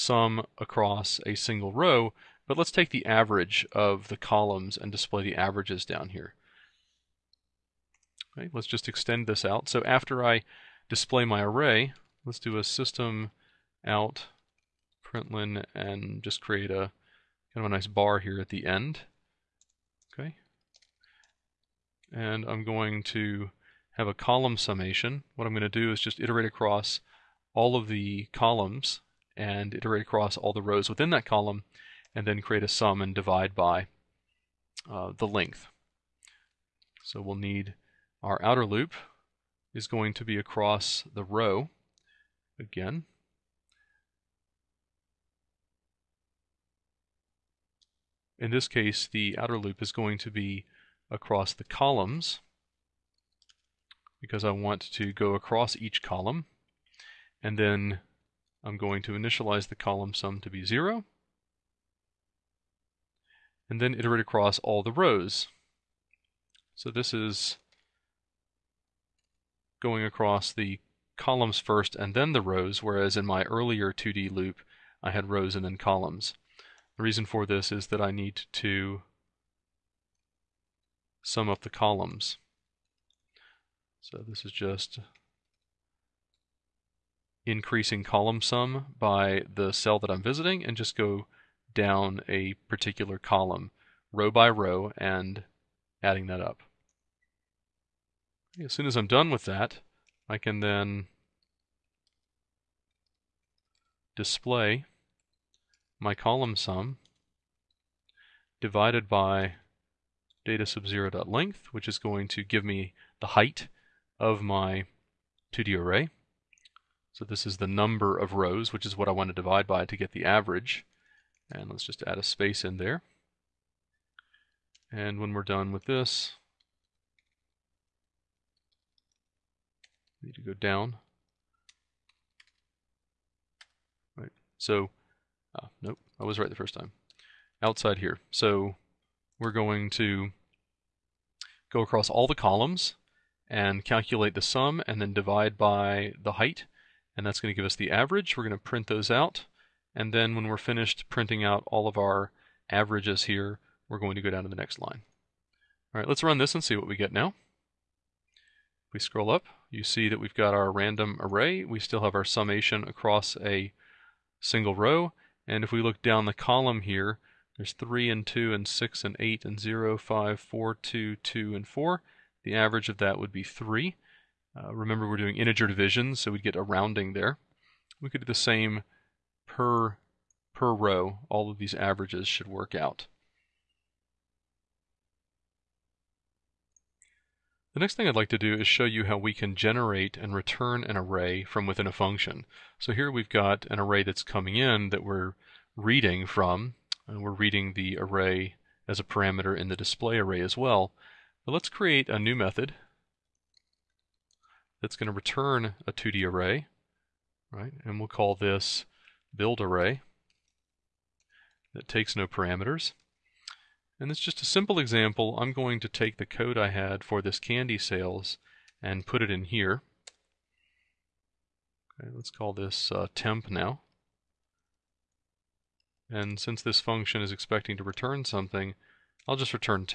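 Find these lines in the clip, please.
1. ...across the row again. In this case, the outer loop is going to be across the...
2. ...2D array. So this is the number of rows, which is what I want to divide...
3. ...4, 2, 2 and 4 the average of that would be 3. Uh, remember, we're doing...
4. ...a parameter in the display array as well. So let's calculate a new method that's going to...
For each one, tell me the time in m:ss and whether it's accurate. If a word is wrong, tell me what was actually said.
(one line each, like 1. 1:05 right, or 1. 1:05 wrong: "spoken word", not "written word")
1. 0:40 right
2. 1:55 right
3. 2:50 right
4. 3:18 wrong: "create", not "calculate".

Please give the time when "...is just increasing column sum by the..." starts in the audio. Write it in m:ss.
1:24.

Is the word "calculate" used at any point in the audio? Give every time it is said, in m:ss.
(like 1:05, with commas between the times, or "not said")
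2:23.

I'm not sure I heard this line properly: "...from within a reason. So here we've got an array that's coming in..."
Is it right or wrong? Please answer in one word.
wrong.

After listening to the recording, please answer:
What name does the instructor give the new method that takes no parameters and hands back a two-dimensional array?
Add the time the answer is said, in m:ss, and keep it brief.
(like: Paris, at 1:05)
build array, at 3:29.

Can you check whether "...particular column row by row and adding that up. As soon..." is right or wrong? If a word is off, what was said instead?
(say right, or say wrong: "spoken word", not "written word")
right.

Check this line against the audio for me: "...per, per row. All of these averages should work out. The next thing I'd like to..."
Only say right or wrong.
right.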